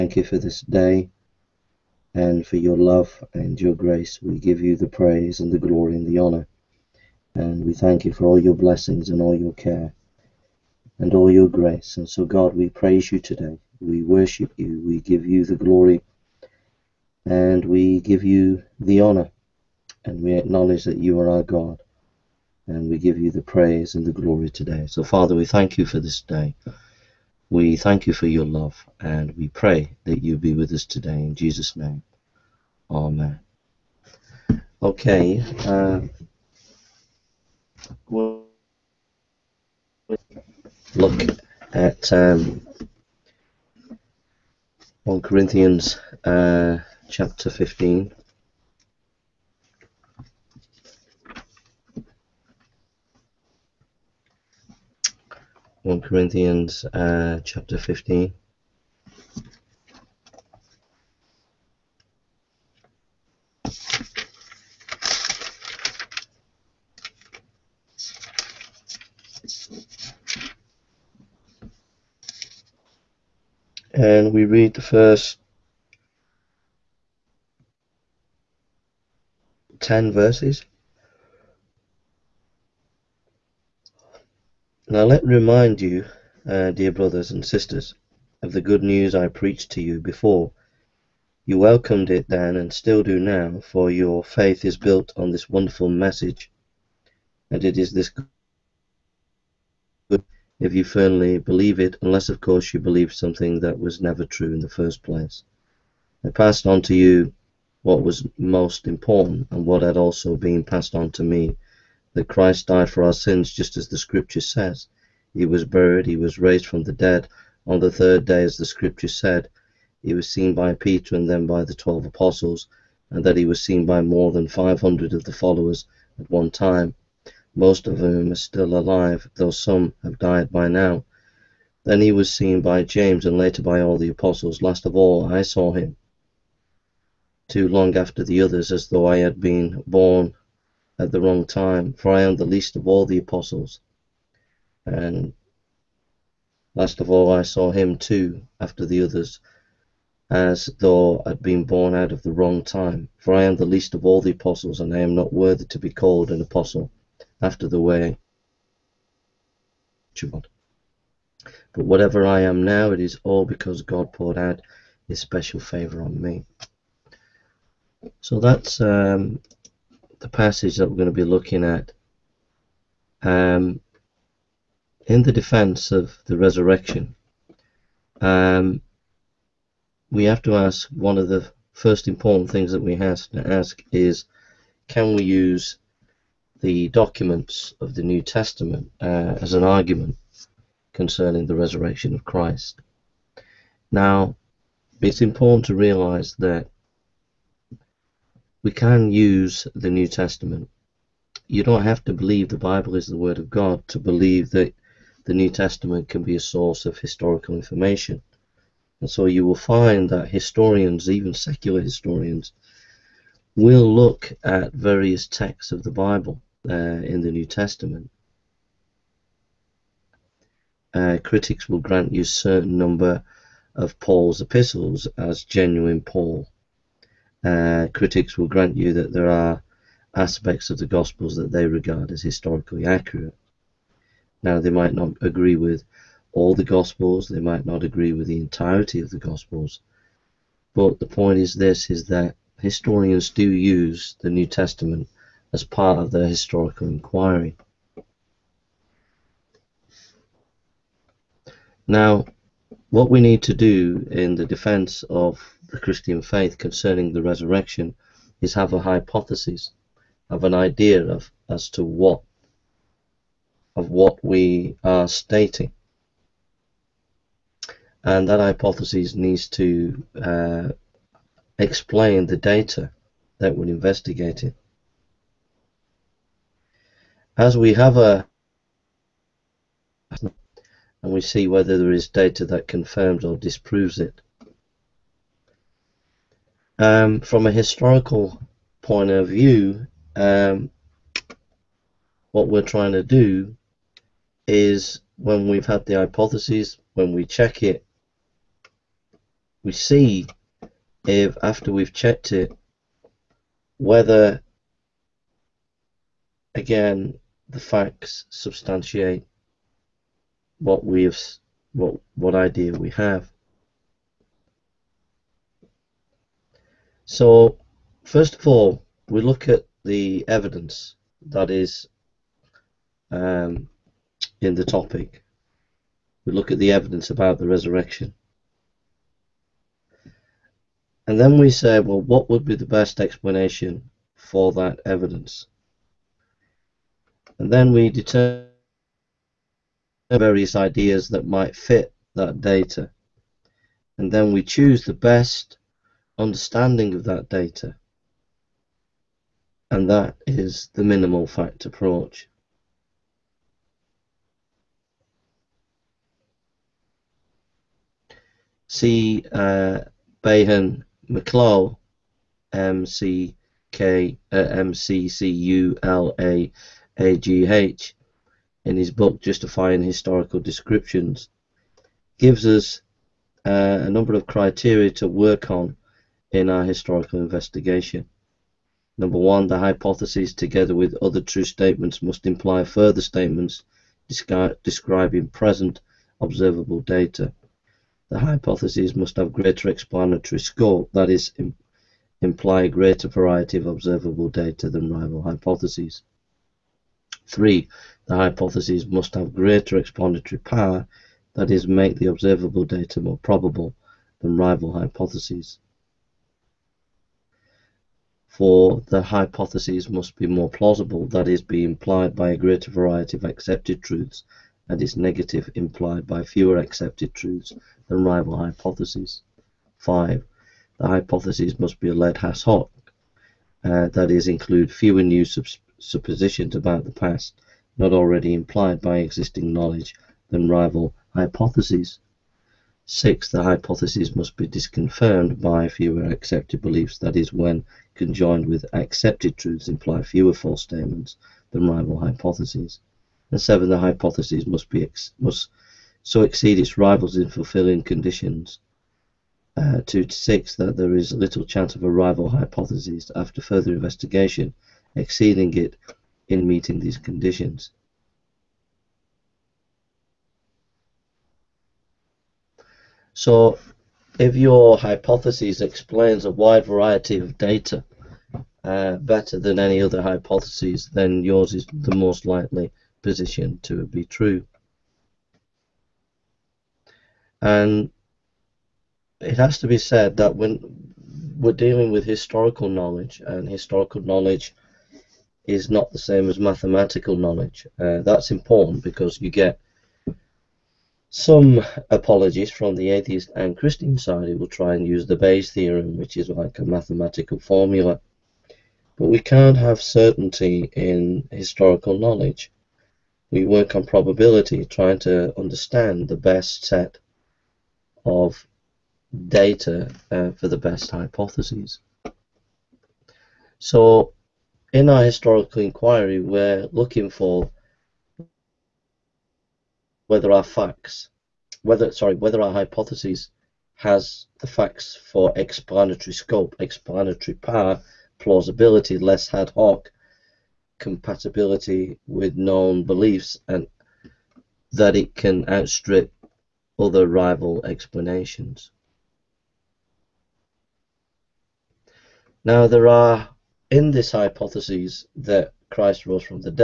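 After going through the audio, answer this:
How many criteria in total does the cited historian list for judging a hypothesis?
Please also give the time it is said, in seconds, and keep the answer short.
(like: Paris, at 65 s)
7, at 443 s.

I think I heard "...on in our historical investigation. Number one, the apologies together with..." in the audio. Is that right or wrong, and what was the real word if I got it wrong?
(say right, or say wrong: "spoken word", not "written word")
wrong: "hypotheses", not "apologies".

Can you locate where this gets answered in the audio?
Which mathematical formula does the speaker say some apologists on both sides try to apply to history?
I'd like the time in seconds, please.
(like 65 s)
495 s.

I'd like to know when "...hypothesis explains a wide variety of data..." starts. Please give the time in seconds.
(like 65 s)
464 s.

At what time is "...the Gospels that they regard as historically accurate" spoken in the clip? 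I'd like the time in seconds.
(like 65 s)
230 s.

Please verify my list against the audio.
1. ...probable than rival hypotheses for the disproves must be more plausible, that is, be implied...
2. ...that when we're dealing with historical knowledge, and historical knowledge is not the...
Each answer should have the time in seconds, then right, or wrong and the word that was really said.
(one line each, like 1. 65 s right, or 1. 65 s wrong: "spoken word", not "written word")
1. 403 s wrong: "hypotheses", not "disproves"
2. 480 s right.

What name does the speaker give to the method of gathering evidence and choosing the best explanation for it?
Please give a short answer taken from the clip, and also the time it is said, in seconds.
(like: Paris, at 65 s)
minimal fact approach, at 350 s.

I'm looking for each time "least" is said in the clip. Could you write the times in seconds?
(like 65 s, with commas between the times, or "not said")
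142 s, 153 s.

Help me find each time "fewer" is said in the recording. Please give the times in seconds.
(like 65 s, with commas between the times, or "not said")
416 s, 424 s, 435 s, 440 s.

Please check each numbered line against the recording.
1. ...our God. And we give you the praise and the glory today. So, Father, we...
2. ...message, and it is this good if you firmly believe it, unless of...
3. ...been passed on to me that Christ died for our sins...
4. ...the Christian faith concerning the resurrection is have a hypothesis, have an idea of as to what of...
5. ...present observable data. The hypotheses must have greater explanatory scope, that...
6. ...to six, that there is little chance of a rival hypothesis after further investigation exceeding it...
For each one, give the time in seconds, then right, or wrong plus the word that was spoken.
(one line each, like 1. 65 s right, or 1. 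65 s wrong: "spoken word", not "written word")
1. 21 s right
2. 95 s right
3. 110 s right
4. 255 s right
5. 385 s right
6. 450 s right.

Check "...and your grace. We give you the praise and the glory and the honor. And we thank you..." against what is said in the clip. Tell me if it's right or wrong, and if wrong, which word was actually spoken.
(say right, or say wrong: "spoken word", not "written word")
right.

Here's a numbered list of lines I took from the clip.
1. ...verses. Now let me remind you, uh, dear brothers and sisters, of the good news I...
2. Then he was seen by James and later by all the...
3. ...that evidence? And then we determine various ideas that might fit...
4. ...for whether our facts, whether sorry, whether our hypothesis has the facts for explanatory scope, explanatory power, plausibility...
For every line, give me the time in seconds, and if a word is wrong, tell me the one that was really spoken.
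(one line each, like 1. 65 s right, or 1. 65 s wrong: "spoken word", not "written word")
1. 80 s right
2. 131 s right
3. 334 s right
4. 517 s right.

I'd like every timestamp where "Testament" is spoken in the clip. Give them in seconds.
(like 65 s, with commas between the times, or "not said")
188 s, 200 s, 205 s, 217 s, 244 s.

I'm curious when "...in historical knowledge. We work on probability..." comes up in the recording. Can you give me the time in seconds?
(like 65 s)
500 s.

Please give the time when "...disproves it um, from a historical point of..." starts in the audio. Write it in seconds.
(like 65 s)
283 s.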